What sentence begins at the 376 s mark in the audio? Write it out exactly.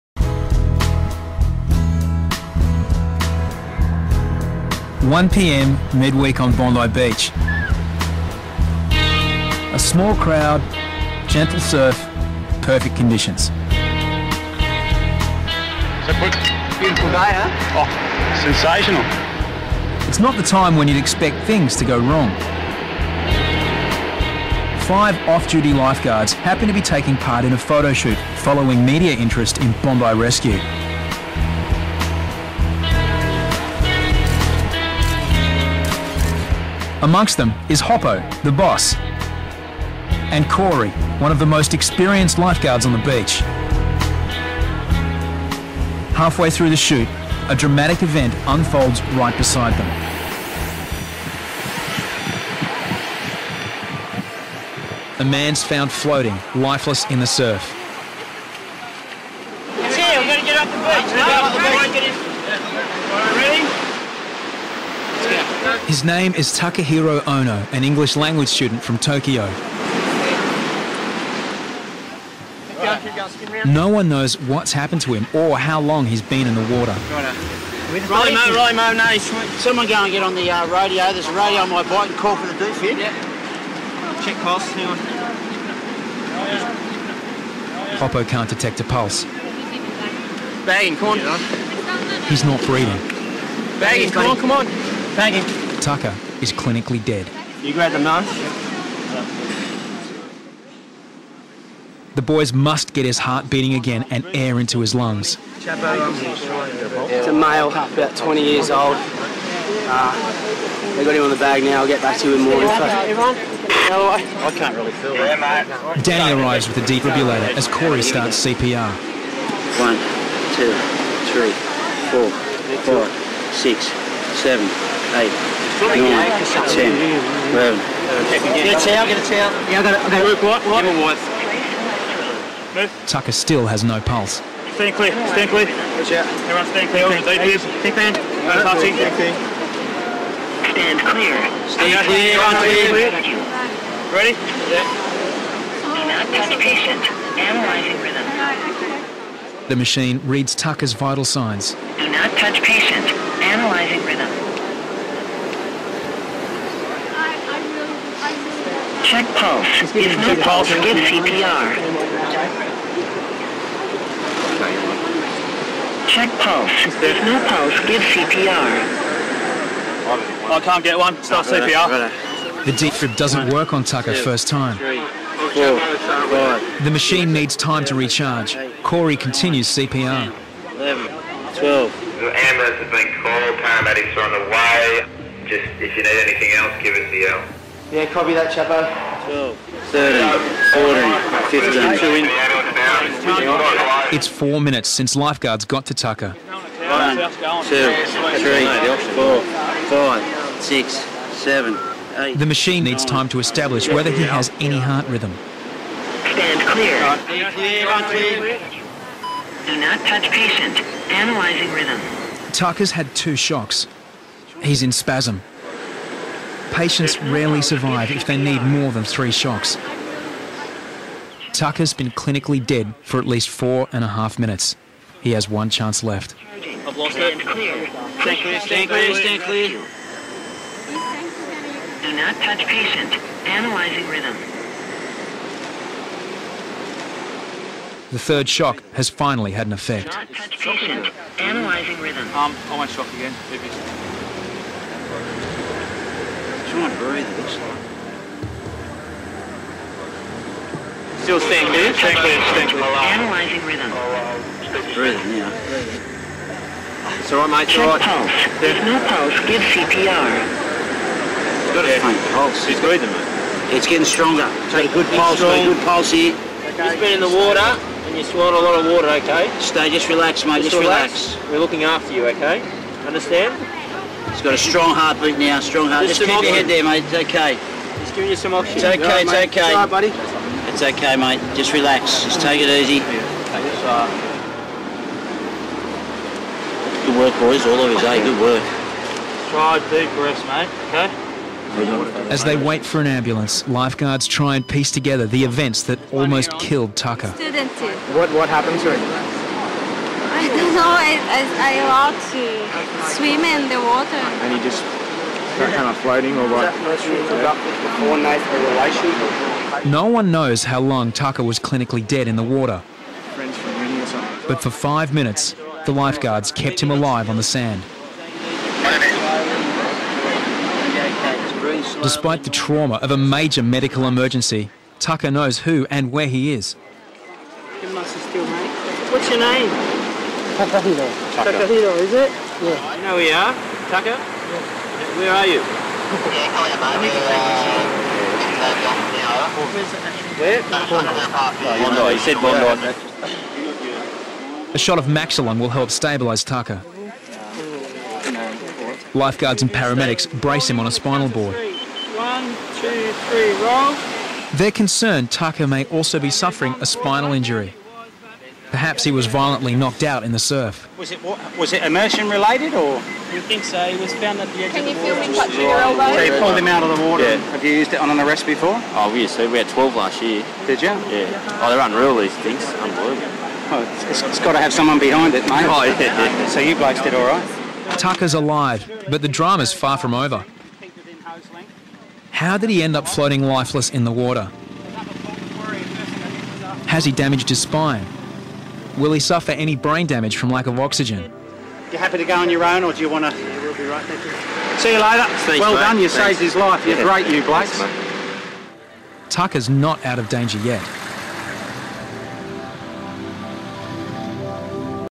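So you blokes did all right?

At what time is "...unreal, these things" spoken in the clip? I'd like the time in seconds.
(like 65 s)
371 s.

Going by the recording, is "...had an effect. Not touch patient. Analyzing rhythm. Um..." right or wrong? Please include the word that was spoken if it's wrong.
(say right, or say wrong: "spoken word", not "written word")
right.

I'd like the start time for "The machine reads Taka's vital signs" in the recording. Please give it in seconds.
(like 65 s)
149 s.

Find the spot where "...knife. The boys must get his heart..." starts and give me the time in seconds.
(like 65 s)
97 s.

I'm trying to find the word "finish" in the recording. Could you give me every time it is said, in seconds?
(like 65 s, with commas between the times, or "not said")
not said.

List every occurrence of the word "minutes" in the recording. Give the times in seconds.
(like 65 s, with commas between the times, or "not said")
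194 s, 224 s, 315 s.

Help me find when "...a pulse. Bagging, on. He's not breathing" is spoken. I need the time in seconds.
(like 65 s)
88 s.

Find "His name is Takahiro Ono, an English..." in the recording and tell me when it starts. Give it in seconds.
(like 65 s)
65 s.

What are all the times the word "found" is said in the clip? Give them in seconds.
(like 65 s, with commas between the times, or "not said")
55 s, 364 s.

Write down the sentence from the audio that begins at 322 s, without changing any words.
Despite the trauma of a major medical emergency, Taka knows who and where he is.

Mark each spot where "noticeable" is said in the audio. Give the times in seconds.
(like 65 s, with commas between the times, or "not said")
not said.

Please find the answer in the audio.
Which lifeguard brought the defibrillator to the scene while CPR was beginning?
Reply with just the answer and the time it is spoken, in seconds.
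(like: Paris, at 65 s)
Danny, at 116 s.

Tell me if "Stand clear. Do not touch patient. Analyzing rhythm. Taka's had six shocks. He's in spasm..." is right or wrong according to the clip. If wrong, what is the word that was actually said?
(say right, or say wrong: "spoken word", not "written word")
wrong: "two", not "six".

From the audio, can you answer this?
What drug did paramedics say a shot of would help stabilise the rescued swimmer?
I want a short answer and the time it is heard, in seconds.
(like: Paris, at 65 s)
Maxolon, at 345 s.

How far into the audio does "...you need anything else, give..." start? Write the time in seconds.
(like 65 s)
185 s.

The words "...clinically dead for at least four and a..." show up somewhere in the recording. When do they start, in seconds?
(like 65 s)
222 s.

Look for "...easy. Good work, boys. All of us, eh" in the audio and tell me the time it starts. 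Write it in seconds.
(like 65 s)
282 s.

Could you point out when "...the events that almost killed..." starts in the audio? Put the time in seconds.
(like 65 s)
295 s.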